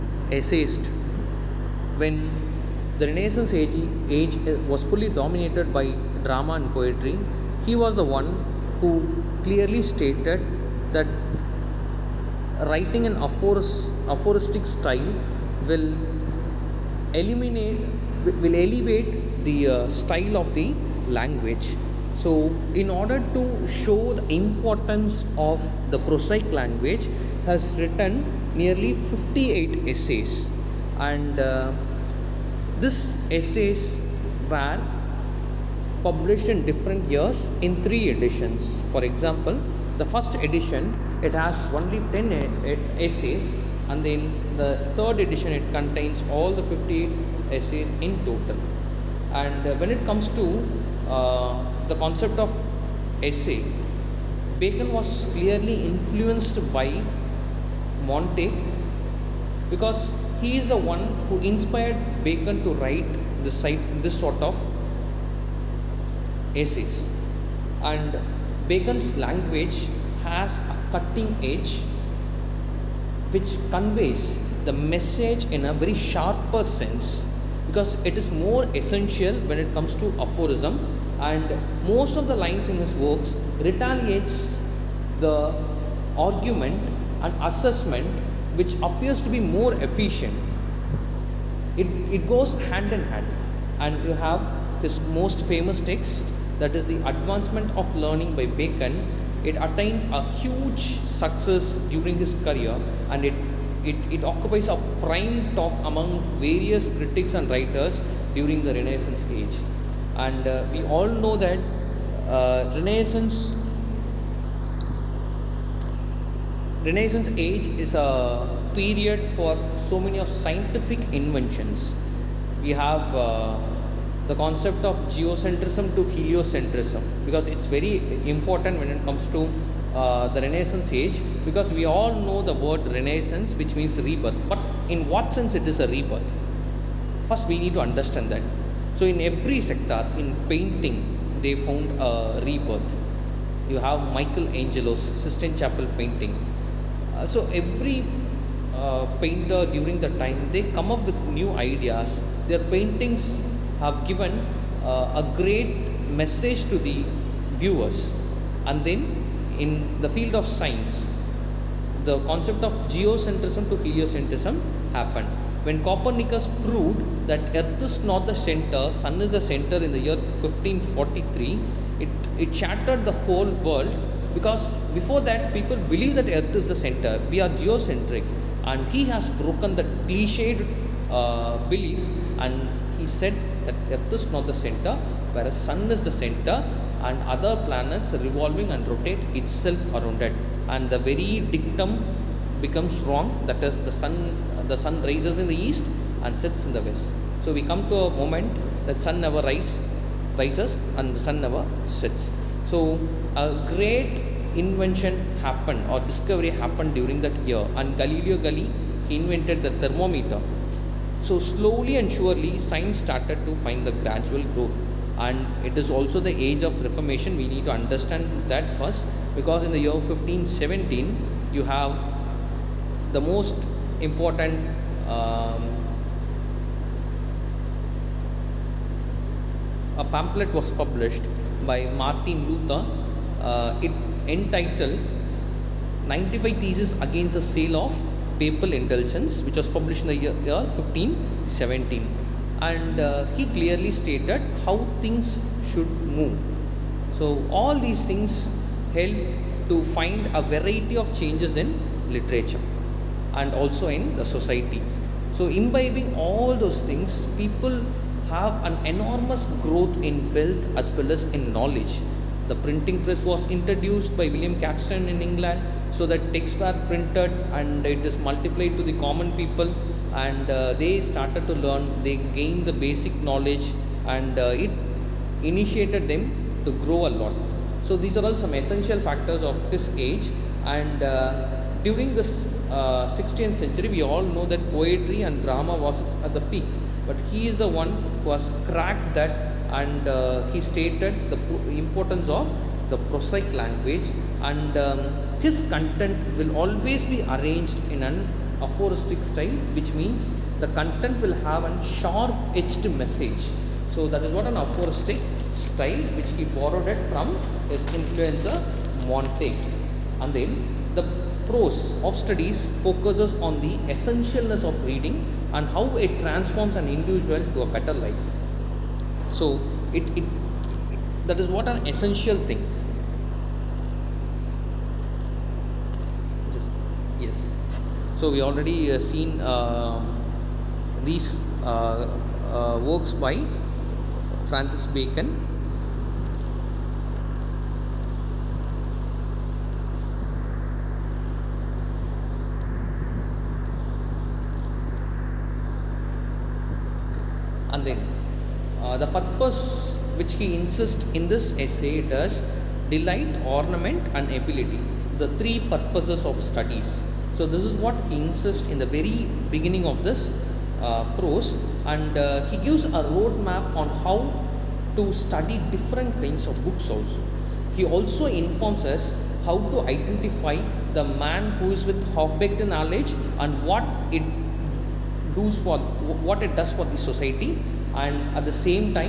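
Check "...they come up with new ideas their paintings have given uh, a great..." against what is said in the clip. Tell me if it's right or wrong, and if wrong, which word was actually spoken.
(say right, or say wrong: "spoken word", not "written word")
right.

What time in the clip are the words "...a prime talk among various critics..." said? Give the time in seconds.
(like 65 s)
104 s.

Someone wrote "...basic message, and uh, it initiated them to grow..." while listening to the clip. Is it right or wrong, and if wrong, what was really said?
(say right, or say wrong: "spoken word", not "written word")
wrong: "knowledge", not "message".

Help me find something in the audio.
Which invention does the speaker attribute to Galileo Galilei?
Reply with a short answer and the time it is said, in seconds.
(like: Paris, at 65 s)
Thermometer, at 209 s.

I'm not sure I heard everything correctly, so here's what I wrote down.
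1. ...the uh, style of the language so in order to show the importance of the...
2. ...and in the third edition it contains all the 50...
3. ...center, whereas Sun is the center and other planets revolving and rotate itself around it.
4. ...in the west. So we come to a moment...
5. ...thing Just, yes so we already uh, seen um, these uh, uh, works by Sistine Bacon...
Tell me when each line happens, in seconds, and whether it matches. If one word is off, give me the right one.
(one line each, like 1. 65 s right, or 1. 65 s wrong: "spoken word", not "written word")
1. 19 s right
2. 43 s right
3. 184 s right
4. 196 s right
5. 322 s wrong: "Francis", not "Sistine".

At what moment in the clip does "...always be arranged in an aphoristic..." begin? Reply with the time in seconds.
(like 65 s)
296 s.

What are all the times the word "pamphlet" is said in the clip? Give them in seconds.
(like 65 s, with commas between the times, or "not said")
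230 s.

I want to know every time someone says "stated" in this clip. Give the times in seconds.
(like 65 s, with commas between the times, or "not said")
9 s, 243 s, 290 s.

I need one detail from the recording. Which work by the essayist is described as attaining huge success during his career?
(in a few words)
The Advancement of Learning.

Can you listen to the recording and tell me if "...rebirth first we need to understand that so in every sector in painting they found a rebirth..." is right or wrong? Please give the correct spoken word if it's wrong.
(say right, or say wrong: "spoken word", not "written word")
right.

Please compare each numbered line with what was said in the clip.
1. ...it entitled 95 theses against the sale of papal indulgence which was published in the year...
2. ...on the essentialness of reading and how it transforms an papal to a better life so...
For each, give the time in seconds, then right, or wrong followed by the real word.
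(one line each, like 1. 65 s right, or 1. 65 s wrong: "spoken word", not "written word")
1. 233 s right
2. 313 s wrong: "individual", not "papal".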